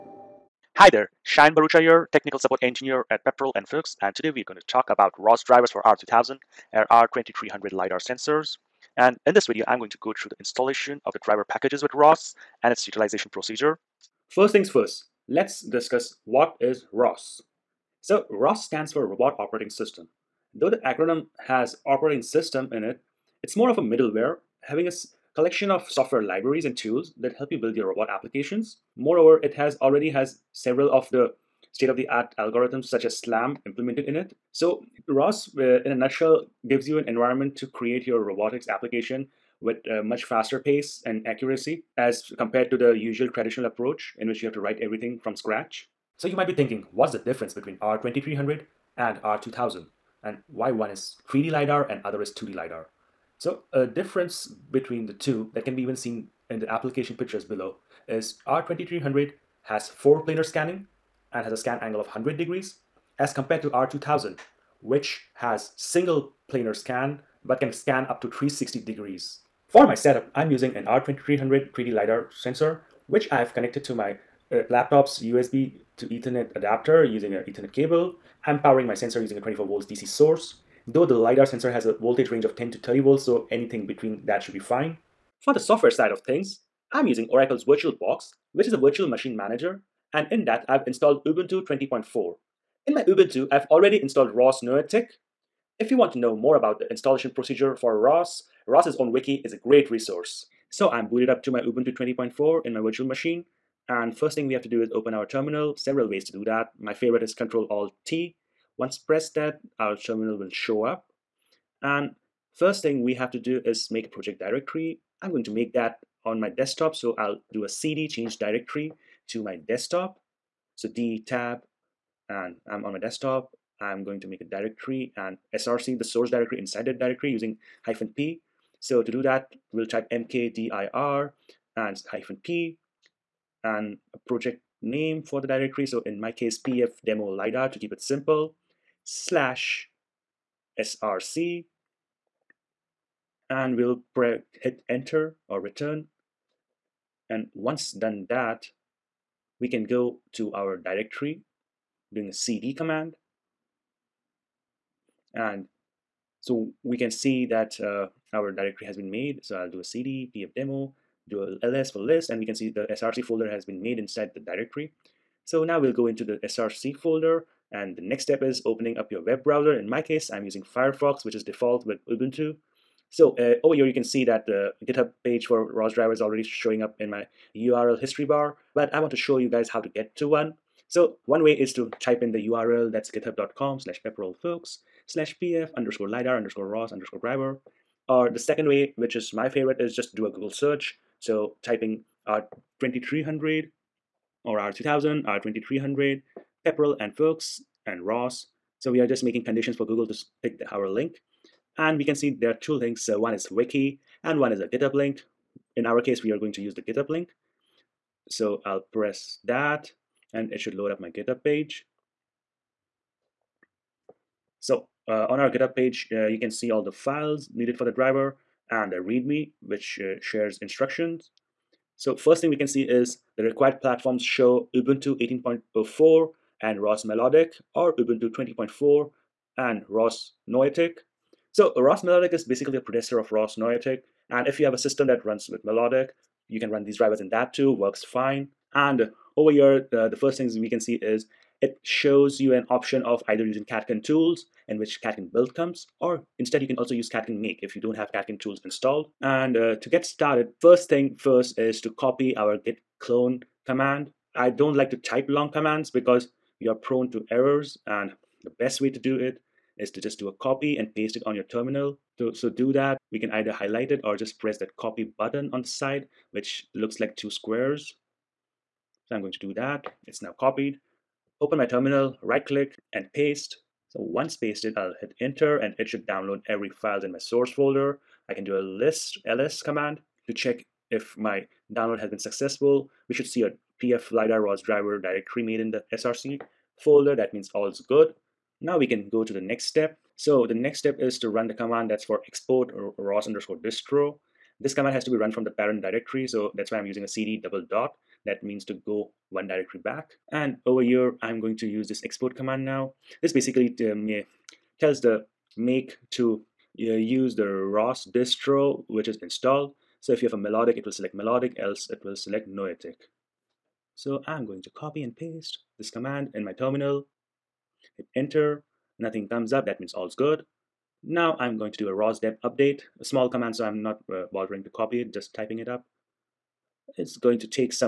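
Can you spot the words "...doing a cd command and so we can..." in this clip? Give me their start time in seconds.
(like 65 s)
152 s.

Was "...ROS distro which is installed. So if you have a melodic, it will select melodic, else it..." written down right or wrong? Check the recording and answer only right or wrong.
right.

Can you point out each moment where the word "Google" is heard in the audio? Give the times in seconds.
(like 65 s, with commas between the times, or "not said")
190 s, 199 s.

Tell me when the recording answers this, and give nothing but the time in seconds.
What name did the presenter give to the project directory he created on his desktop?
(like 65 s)
136 s.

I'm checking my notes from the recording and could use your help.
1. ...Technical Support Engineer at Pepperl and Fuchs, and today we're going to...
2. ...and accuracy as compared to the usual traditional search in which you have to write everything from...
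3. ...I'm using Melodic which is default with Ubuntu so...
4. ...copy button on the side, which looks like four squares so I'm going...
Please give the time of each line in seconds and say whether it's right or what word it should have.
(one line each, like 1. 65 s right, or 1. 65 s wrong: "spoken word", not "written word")
1. 2 s right
2. 41 s wrong: "approach", not "search"
3. 170 s wrong: "Firefox", not "Melodic"
4. 264 s wrong: "two", not "four".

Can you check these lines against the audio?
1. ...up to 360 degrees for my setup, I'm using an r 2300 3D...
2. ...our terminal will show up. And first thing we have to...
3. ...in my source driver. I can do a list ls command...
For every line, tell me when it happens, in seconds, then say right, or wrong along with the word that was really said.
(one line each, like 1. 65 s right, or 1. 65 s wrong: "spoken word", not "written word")
1. 68 s right
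2. 109 s right
3. 277 s wrong: "folder", not "driver".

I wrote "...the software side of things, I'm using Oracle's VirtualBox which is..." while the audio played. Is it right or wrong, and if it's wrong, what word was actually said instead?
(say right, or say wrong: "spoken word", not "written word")
right.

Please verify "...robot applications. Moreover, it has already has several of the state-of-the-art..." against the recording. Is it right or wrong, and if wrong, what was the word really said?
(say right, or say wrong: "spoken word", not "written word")
right.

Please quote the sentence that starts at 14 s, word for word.
First things first, let's discuss what is ROS.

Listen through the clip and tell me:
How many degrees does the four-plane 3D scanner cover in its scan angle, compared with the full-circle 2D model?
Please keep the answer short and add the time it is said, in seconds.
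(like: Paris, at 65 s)
100 degrees, at 62 s.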